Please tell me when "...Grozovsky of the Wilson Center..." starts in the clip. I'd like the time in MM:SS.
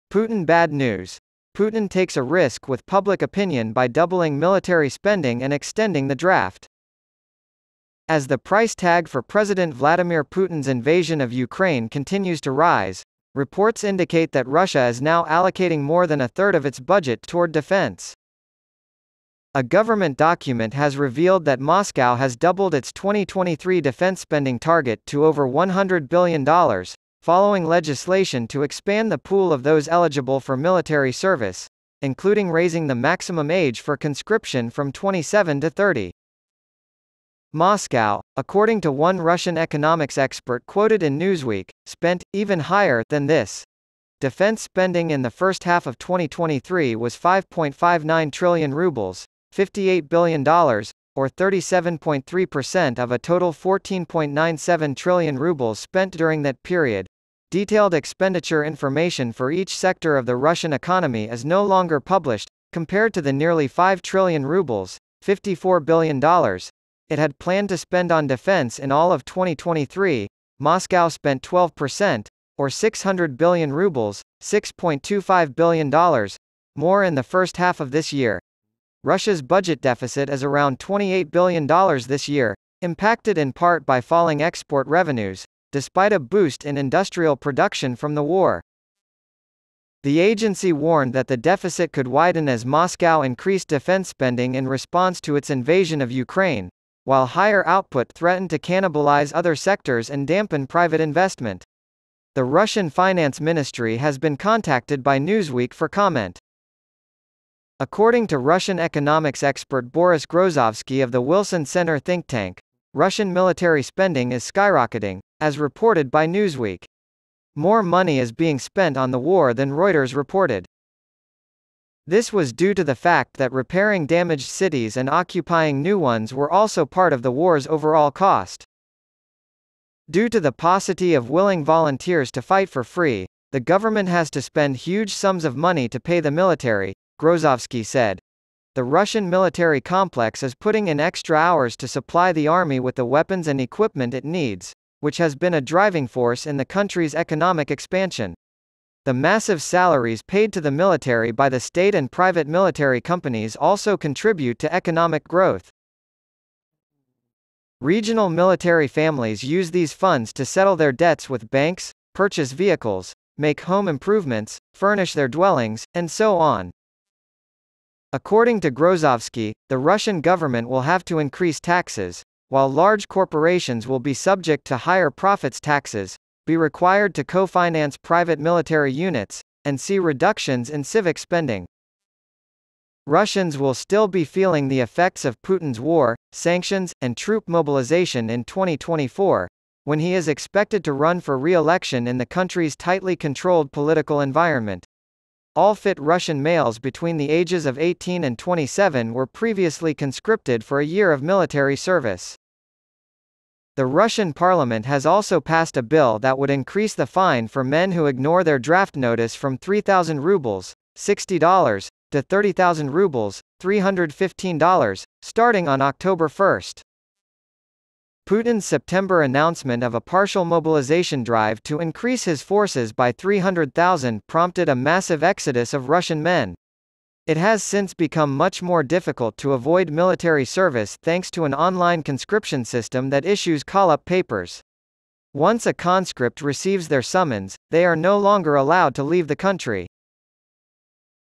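01:50.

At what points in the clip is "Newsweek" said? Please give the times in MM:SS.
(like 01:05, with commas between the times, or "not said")
00:41, 01:45, 01:56.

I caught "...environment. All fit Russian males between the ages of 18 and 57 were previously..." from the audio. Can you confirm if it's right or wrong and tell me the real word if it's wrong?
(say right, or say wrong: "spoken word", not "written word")
wrong: "27", not "57".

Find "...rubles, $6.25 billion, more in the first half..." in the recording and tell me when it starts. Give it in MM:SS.
01:13.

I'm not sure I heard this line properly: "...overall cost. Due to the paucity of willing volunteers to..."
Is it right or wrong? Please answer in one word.
right.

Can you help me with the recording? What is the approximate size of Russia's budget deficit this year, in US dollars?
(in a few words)
$28 billion.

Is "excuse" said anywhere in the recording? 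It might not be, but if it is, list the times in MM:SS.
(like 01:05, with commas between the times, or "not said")
not said.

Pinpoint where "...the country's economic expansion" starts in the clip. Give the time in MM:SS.
02:26.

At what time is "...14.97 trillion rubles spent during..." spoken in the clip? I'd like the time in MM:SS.
00:53.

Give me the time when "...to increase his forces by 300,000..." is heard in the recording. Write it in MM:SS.
03:41.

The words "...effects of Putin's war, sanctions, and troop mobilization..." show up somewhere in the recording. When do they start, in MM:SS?
03:04.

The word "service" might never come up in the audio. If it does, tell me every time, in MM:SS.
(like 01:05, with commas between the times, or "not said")
00:31, 03:21, 03:50.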